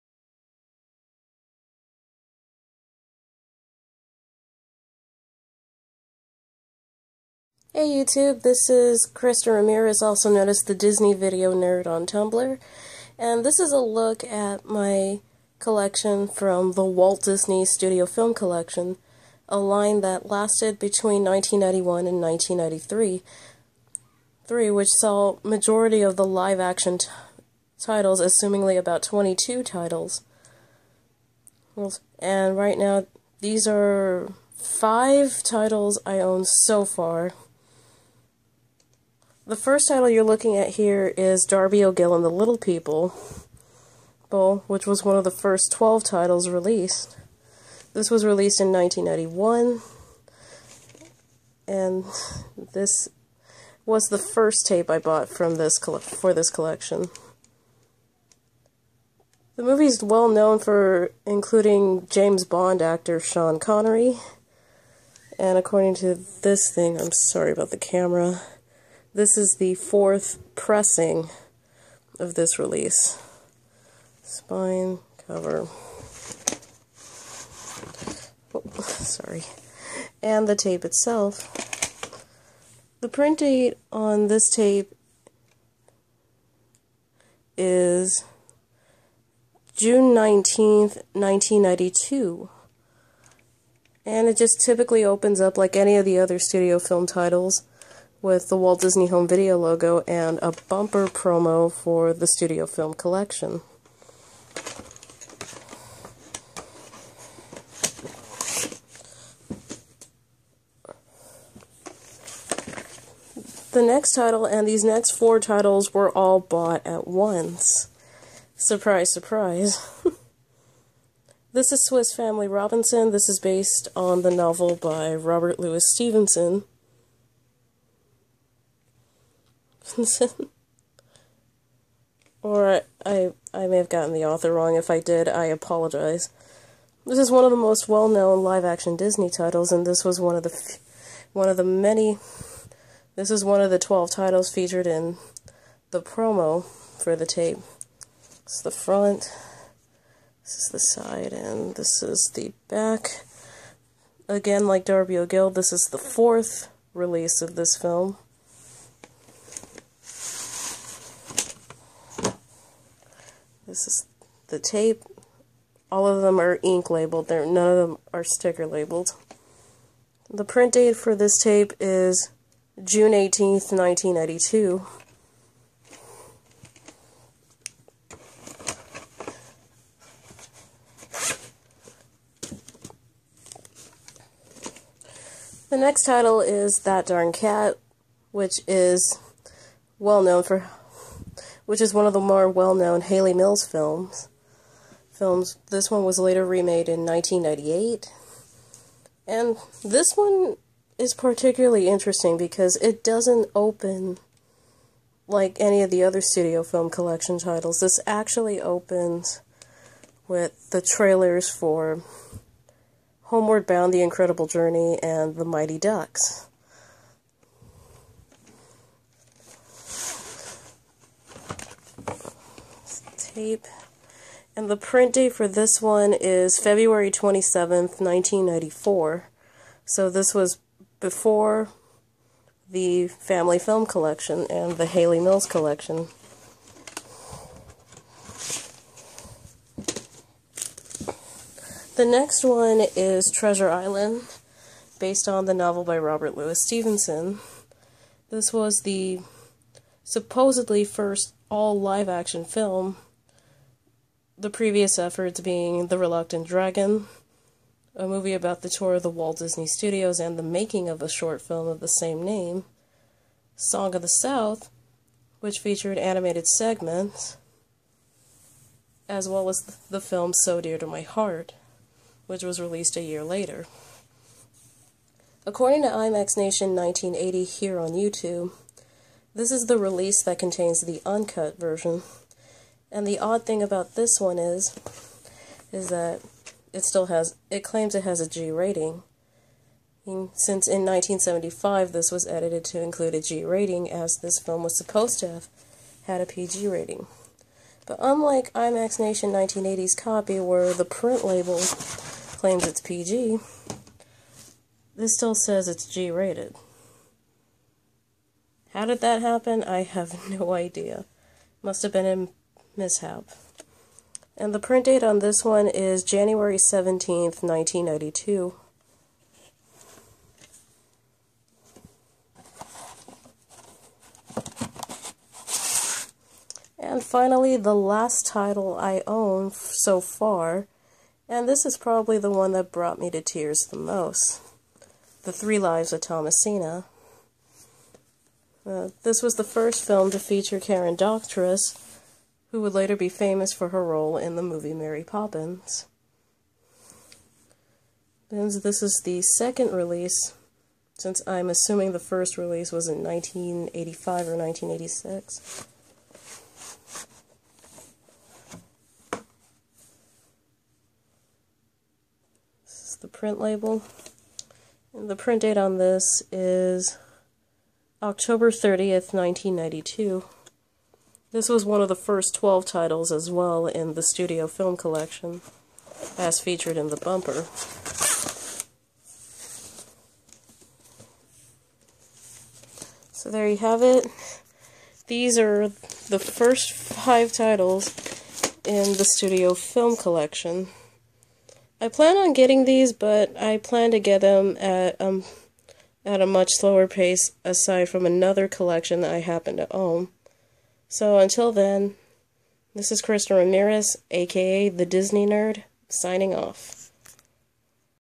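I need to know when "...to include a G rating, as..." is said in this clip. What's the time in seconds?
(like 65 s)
292 s.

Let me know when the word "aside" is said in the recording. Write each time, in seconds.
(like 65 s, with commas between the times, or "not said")
397 s.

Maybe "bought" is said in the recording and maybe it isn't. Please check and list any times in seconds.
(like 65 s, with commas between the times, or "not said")
54 s, 116 s.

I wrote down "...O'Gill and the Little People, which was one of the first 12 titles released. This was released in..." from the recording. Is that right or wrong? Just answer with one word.
right.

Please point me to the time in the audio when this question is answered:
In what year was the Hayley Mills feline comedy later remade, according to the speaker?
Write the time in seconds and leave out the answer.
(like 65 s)
197 s.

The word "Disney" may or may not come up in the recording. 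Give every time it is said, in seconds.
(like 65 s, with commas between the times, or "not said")
10 s, 17 s, 98 s, 138 s, 259 s, 404 s.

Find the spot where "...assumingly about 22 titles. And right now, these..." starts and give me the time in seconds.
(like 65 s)
28 s.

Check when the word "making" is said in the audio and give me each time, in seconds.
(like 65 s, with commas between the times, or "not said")
260 s.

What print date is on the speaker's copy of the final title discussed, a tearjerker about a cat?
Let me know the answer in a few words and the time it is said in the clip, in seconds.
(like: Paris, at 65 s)
October 30, 1992, at 368 s.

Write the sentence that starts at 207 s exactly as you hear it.
This actually opens with the trailers for Homeward Bound, The Incredible Journey, and The Mighty Ducks.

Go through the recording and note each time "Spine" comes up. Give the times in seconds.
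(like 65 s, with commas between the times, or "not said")
74 s.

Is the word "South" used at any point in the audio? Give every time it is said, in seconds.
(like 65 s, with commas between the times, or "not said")
264 s.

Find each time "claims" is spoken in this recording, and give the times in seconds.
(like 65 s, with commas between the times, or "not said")
287 s, 302 s.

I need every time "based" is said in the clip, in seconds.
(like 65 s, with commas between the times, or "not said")
123 s, 244 s.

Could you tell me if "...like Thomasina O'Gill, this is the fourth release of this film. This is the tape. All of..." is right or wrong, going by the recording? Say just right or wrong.
wrong.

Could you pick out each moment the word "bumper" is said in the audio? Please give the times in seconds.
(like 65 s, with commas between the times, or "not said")
100 s, 376 s.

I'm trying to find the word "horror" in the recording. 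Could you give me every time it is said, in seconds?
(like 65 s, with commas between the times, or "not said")
not said.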